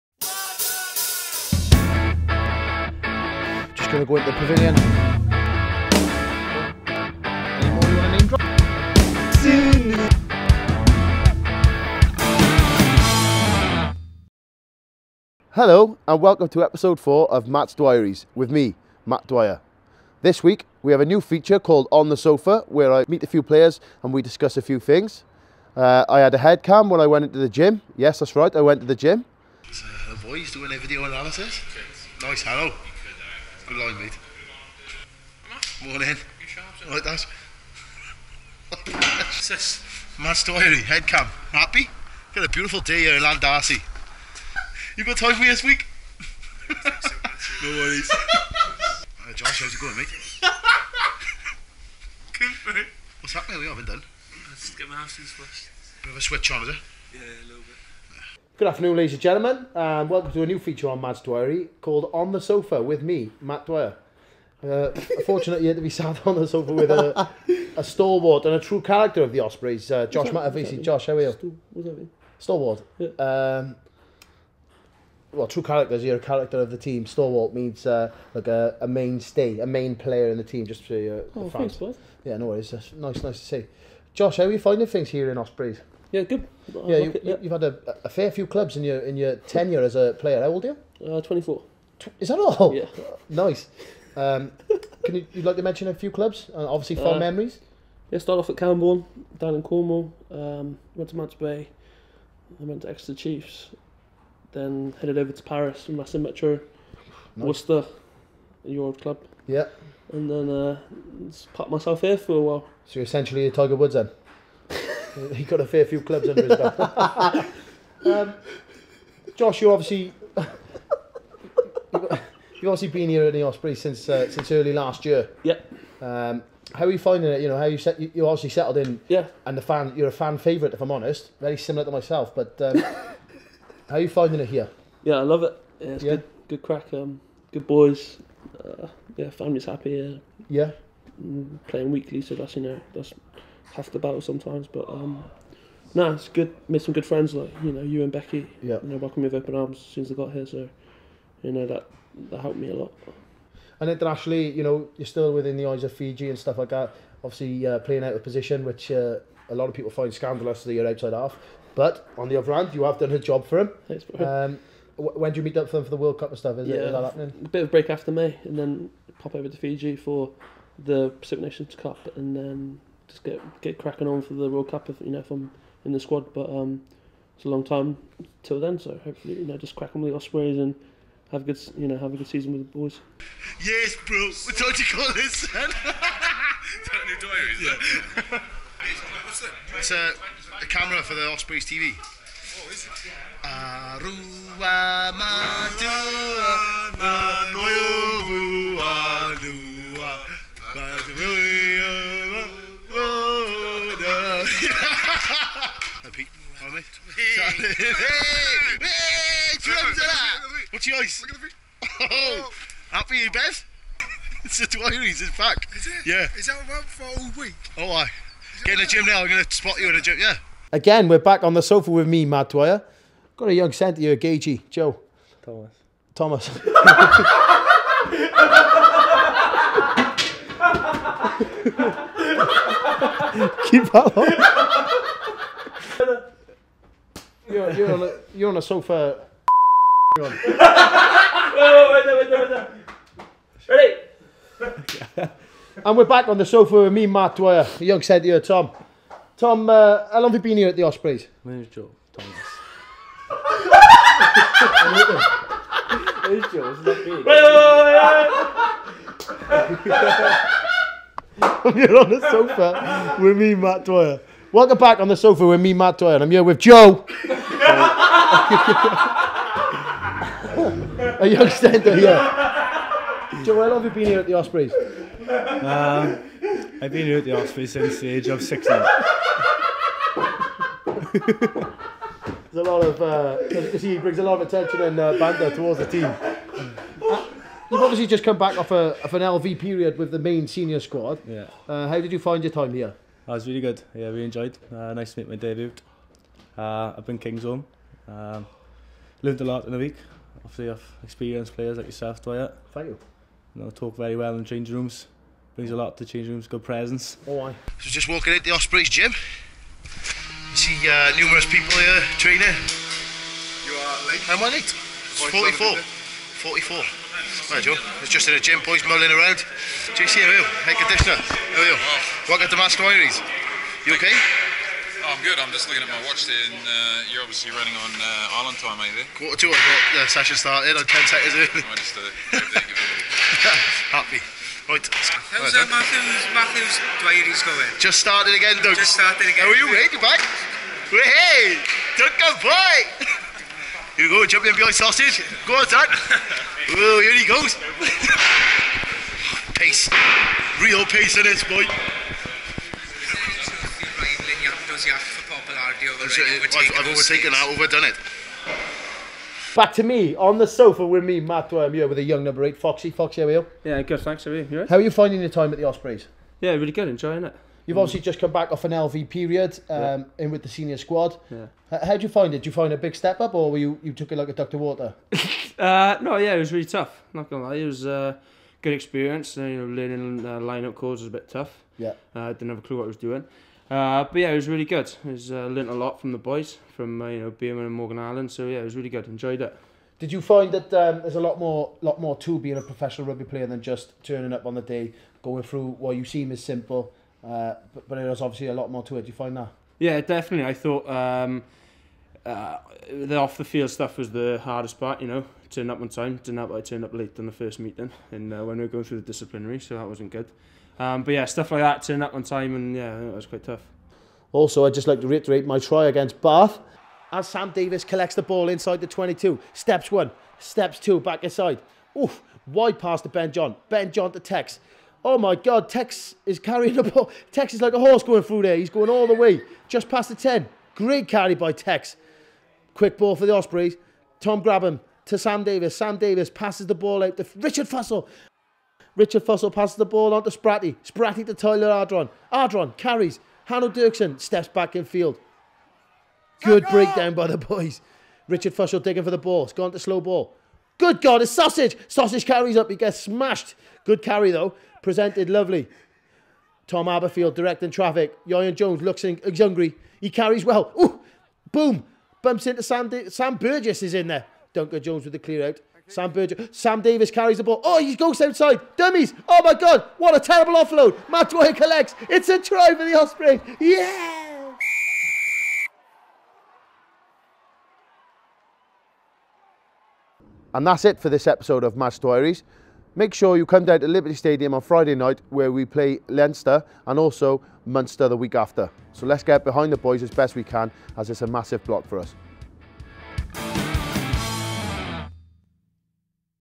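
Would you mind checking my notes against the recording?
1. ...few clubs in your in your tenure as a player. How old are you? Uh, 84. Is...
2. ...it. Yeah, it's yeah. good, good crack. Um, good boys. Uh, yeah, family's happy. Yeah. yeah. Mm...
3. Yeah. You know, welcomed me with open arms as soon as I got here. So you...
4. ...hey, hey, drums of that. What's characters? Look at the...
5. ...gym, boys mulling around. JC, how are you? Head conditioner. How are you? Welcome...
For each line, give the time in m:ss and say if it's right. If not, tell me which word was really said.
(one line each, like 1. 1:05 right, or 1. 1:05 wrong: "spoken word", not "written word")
1. 1:28 wrong: "24", not "84"
2. 2:15 right
3. 2:28 right
4. 3:27 wrong: "yours", not "characters"
5. 5:18 right.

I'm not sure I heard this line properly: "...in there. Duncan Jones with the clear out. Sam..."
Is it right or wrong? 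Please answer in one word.
right.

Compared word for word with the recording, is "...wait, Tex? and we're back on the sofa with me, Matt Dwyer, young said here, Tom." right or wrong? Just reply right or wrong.
wrong.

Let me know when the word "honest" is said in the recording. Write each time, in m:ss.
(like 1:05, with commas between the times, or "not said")
2:10.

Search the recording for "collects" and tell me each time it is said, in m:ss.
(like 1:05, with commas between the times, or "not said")
6:57, 7:51.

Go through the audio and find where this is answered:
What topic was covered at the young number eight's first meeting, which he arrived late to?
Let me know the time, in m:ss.
6:49.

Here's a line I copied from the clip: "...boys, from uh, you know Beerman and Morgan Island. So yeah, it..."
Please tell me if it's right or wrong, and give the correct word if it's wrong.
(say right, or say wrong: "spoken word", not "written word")
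right.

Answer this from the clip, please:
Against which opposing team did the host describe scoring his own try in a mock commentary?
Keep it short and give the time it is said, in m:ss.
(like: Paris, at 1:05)
Bath, at 6:56.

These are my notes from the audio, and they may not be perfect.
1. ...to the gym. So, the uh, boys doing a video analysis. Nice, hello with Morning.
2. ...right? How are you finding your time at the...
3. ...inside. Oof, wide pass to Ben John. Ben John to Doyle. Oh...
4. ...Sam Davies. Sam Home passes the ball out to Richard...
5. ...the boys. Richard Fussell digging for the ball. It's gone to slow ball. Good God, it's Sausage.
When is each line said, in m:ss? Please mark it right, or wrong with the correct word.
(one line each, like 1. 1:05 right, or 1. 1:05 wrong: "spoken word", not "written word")
1. 0:28 right
2. 6:04 right
3. 7:01 wrong: "Tex", not "Doyle"
4. 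7:15 wrong: "Davies", not "Home"
5. 7:27 right.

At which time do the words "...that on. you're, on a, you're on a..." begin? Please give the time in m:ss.
3:53.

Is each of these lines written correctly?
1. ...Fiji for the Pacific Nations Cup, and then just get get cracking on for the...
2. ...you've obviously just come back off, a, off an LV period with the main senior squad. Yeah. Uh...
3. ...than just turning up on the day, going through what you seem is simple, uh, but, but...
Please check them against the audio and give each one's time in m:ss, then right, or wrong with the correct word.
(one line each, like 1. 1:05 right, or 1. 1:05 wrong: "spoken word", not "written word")
1. 2:49 right
2. 4:47 right
3. 6:33 right.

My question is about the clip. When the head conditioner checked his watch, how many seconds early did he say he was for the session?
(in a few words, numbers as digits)
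10.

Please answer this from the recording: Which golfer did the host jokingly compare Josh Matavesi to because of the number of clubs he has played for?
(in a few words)
Tiger Woods.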